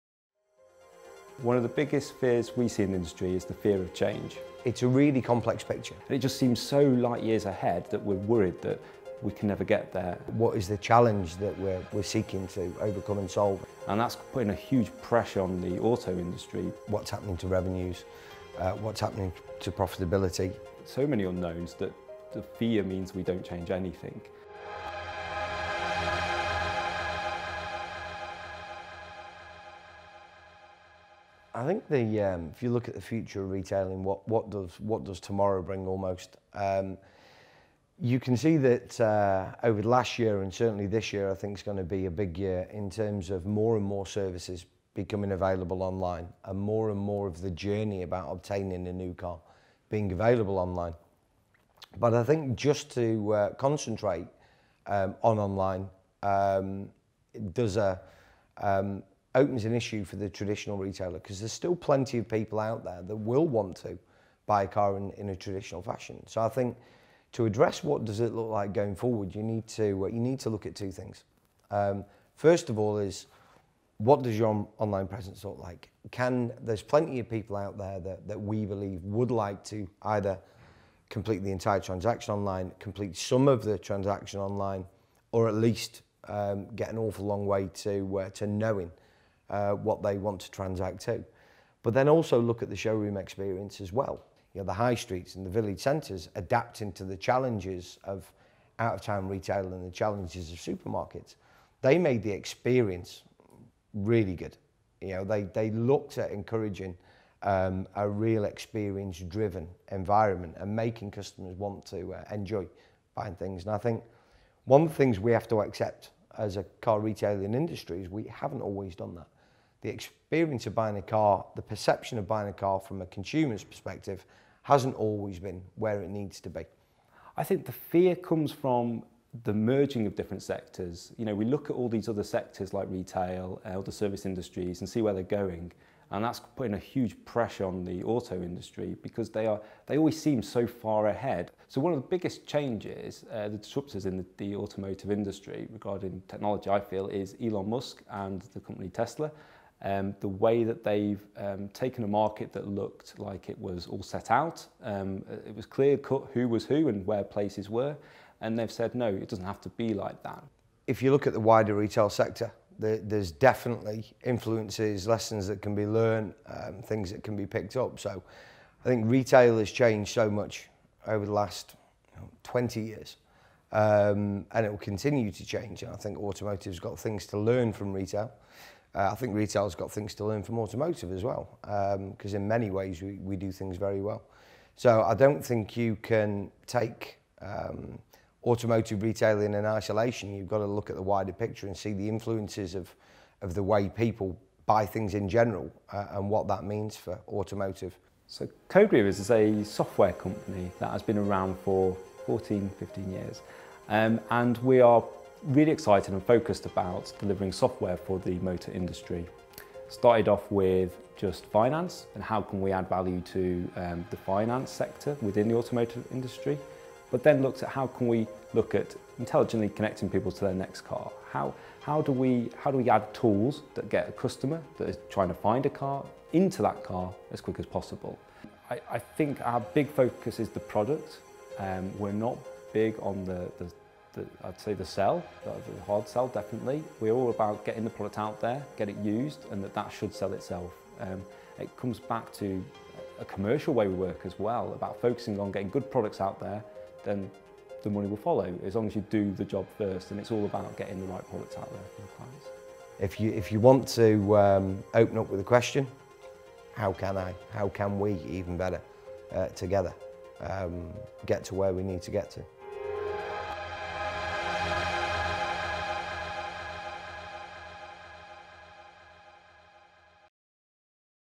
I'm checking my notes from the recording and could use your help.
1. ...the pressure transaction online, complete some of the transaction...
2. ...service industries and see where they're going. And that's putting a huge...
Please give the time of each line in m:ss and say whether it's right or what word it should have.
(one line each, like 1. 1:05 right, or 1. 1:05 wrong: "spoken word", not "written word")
1. 1:21 wrong: "entire", not "pressure"
2. 2:13 right.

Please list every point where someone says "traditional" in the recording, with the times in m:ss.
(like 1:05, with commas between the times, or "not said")
1:00, 1:05.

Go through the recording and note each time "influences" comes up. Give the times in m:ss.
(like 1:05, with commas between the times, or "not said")
2:44, 3:12.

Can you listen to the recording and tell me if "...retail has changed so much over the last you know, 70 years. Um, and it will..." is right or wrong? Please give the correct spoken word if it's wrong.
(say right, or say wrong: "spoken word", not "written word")
wrong: "20", not "70".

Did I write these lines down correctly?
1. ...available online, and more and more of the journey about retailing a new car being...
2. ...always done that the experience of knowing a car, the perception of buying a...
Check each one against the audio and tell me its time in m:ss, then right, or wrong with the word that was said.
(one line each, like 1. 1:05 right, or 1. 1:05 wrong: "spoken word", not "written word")
1. 0:45 wrong: "obtaining", not "retailing"
2. 1:58 wrong: "buying", not "knowing".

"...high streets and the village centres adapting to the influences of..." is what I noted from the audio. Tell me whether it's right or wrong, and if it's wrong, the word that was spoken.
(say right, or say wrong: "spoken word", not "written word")
wrong: "challenges", not "influences".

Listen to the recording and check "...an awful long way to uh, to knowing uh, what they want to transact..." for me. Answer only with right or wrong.
right.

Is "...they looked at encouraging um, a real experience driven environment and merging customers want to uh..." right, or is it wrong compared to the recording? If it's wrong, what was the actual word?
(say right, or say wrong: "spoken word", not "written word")
wrong: "making", not "merging".